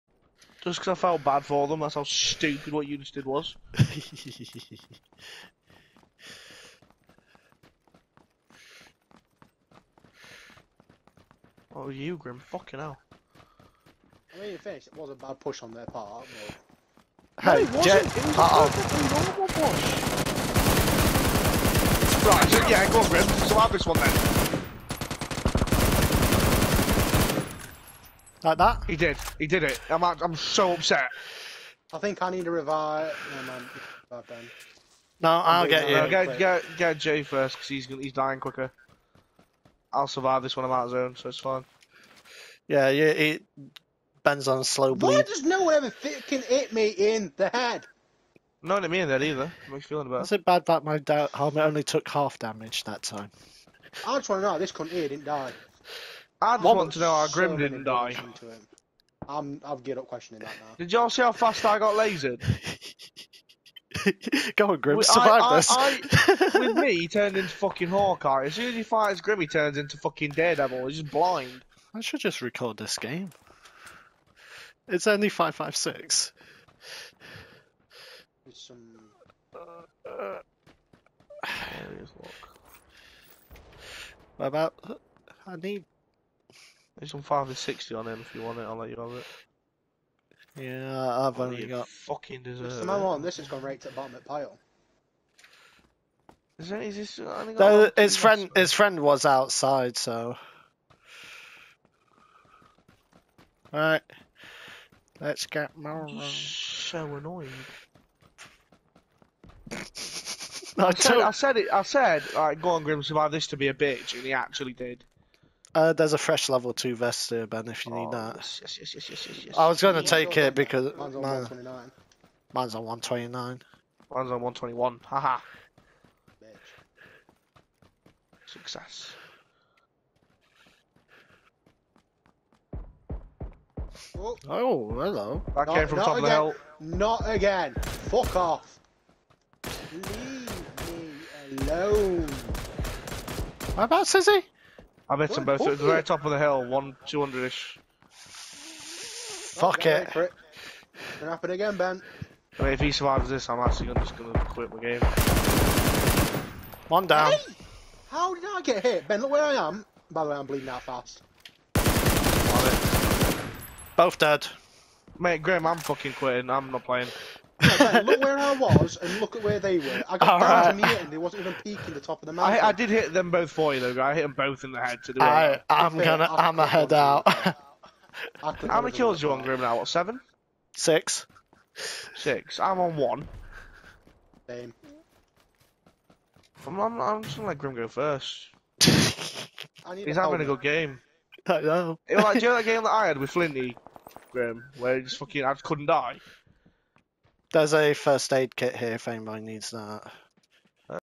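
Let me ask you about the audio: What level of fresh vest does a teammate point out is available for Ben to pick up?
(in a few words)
level two.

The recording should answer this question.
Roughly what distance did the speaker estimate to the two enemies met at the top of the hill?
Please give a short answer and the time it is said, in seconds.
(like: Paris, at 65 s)
200, at 147 s.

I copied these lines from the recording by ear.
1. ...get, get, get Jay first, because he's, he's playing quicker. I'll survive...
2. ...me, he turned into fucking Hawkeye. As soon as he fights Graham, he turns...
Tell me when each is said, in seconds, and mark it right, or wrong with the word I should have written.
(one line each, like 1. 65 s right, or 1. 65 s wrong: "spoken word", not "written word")
1. 36 s wrong: "dying", not "playing"
2. 66 s wrong: "Grim", not "Graham".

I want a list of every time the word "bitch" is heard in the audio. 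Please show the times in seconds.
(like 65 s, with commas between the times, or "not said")
113 s.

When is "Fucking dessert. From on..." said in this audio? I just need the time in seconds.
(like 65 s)
91 s.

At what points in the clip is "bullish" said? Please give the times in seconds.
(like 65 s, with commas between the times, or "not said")
not said.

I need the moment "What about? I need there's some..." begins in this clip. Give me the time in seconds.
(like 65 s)
84 s.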